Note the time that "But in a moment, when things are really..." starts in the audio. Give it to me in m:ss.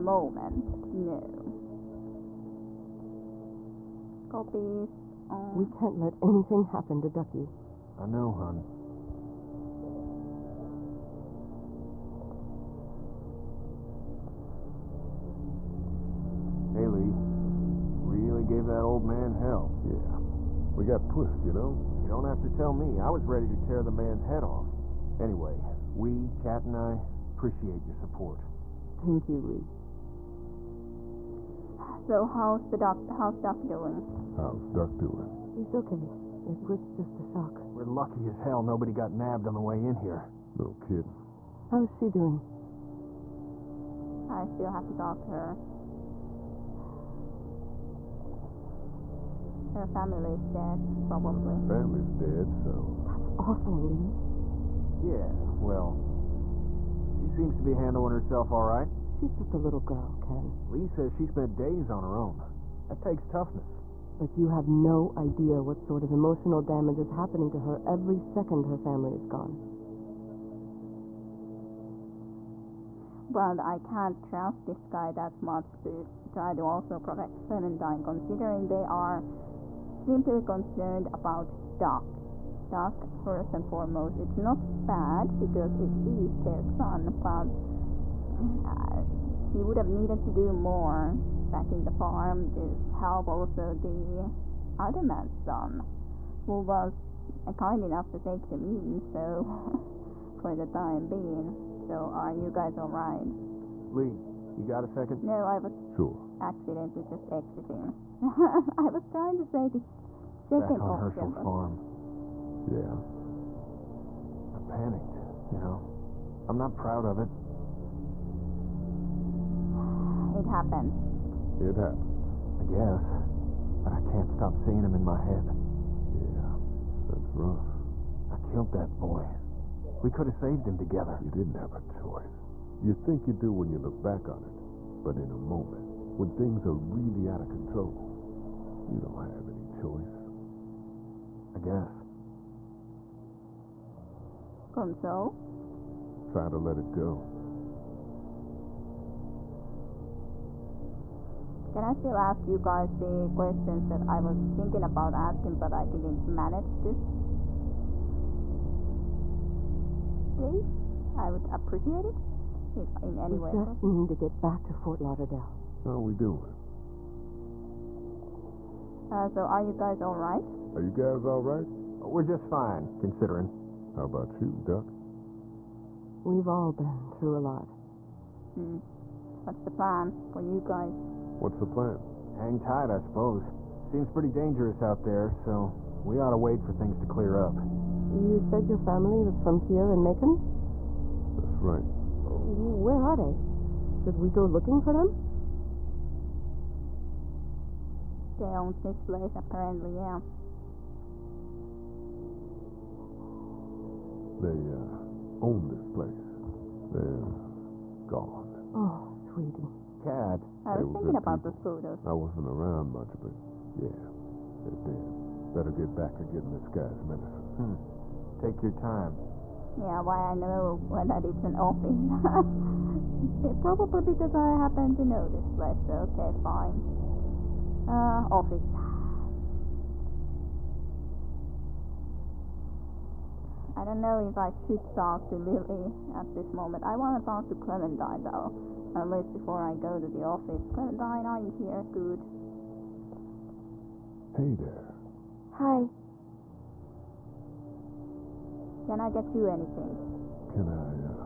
2:15.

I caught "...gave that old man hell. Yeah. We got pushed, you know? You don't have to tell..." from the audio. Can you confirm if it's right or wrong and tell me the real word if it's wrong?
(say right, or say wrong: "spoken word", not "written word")
right.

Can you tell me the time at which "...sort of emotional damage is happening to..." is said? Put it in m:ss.
1:05.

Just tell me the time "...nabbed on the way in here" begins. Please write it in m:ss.
0:39.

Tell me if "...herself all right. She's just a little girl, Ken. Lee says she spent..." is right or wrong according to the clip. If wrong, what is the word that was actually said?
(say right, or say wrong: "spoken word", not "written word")
right.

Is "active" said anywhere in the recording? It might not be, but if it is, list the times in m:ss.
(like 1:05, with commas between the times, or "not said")
not said.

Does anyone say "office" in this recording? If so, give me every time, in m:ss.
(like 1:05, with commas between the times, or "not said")
3:41, 3:48, 4:00.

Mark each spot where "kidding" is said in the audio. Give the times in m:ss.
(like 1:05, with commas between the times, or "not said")
0:40.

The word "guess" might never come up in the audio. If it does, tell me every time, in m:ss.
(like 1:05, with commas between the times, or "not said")
2:02, 2:21.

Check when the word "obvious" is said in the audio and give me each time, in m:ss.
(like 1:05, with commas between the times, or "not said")
not said.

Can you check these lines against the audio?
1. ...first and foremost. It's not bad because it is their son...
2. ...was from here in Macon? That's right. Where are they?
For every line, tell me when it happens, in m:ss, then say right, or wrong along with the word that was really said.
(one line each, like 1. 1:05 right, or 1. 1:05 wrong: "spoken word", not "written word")
1. 1:23 right
2. 3:09 right.